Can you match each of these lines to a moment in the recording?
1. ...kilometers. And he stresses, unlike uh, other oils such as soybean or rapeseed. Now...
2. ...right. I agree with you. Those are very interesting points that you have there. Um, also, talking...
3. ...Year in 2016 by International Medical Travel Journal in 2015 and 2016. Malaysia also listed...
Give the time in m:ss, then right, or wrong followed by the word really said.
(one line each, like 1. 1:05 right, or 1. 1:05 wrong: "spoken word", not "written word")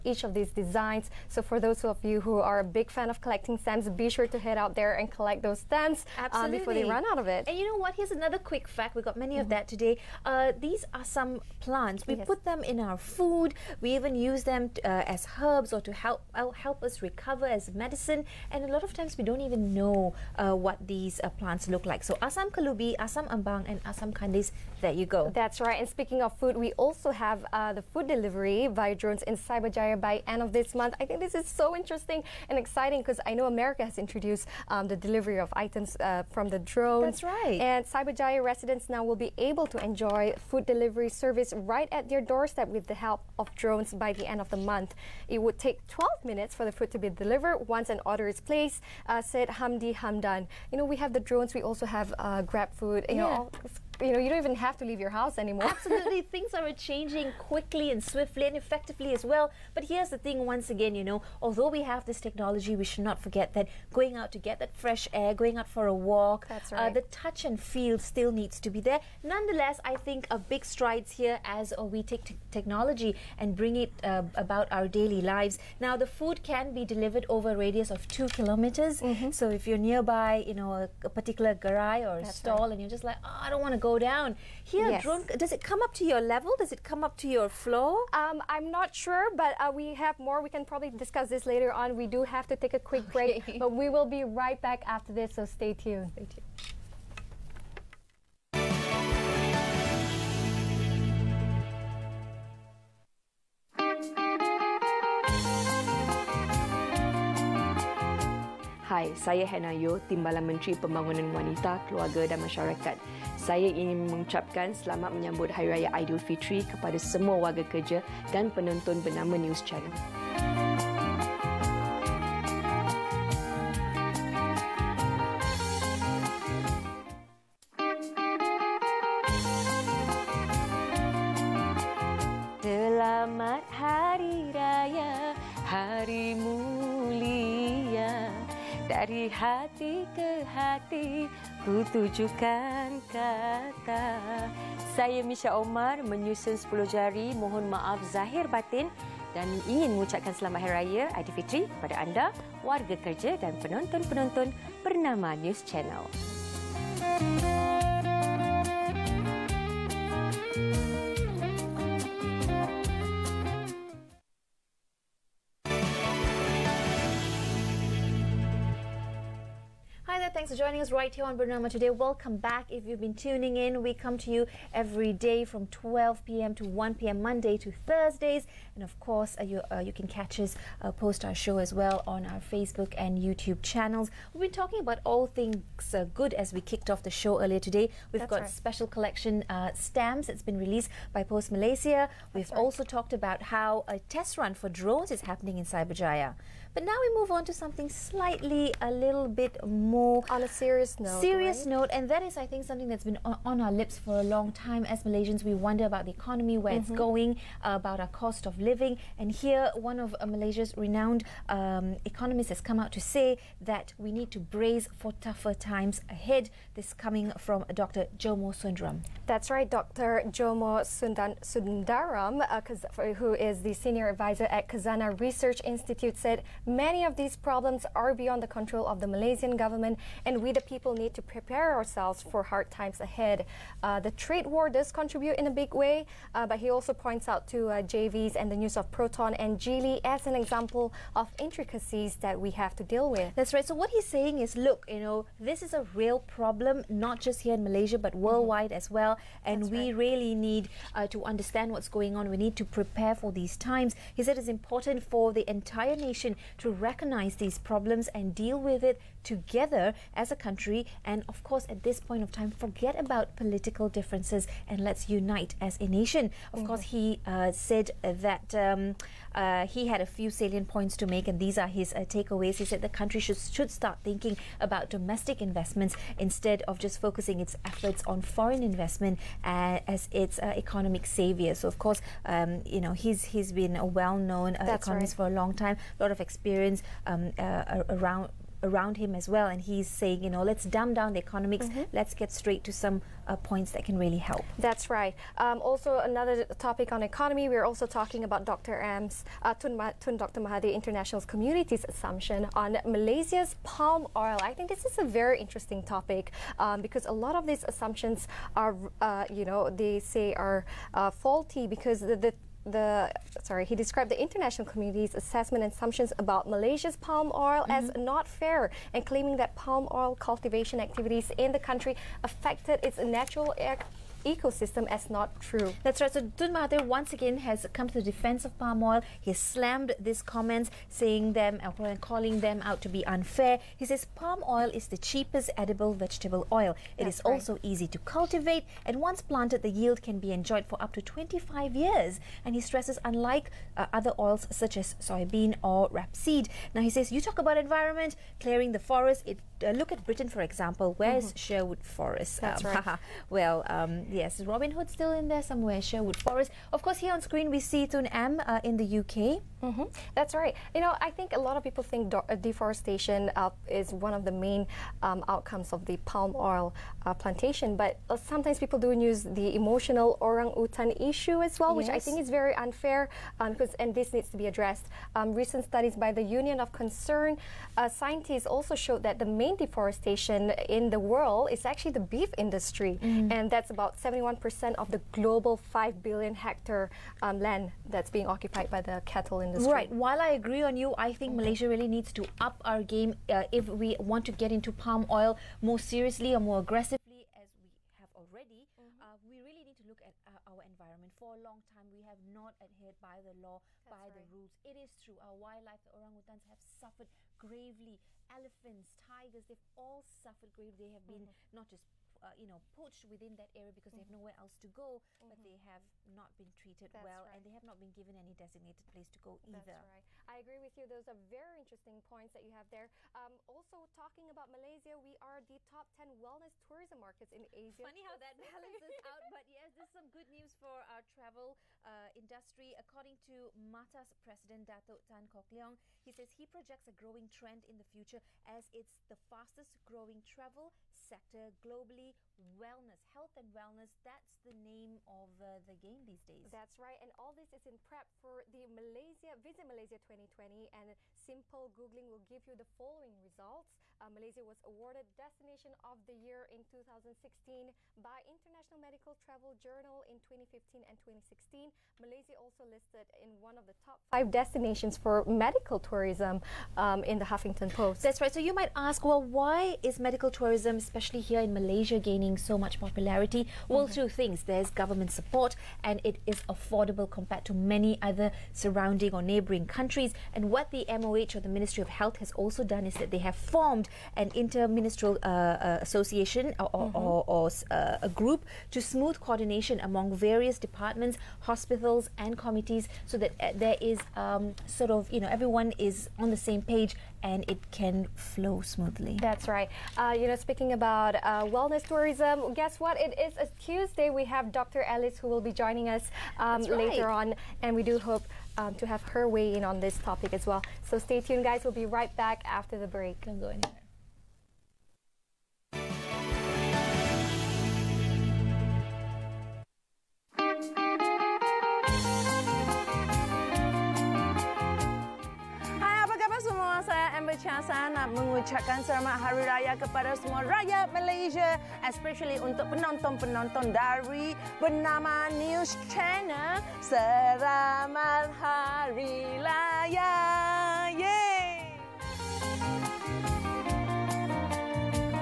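1. 5:41 wrong: "years", not "kilometers"
2. 6:59 right
3. 7:36 right.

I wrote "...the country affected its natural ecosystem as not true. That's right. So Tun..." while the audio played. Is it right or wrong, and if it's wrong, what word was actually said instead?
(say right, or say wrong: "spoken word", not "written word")
right.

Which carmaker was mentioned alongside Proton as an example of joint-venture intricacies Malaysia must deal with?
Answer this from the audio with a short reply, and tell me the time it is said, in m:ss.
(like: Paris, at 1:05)
Geely, at 3:59.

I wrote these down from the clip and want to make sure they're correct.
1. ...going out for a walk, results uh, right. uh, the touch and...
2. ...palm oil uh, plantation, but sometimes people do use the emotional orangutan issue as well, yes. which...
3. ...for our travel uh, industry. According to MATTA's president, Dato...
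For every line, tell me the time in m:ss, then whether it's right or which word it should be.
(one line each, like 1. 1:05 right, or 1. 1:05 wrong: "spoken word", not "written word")
1. 1:05 wrong: "thats", not "results"
2. 6:06 right
3. 7:10 right.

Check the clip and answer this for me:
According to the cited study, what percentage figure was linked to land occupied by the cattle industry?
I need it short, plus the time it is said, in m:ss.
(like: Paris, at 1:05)
71%, at 6:24.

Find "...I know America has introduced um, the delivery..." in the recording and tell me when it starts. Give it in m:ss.
0:33.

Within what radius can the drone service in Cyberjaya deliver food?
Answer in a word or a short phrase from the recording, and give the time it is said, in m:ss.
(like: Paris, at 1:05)
2 kilometers, at 1:18.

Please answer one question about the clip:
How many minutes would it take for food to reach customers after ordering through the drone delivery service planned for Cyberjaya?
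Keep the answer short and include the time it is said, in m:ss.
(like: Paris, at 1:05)
12, at 0:45.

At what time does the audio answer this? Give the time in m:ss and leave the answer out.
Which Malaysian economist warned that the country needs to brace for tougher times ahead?
3:38.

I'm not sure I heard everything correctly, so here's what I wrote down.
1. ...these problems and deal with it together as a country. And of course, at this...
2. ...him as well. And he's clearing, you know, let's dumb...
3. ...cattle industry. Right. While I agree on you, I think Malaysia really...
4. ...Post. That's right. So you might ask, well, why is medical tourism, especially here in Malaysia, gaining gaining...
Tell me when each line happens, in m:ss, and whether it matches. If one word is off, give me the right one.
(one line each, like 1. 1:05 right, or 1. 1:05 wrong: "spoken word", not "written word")
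1. 4:17 right
2. 4:48 wrong: "saying", not "clearing"
3. 6:29 right
4. 7:47 right.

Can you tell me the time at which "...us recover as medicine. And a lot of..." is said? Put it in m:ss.
0:16.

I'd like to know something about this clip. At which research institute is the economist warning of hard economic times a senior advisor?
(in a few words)
Khazanah Research Institute.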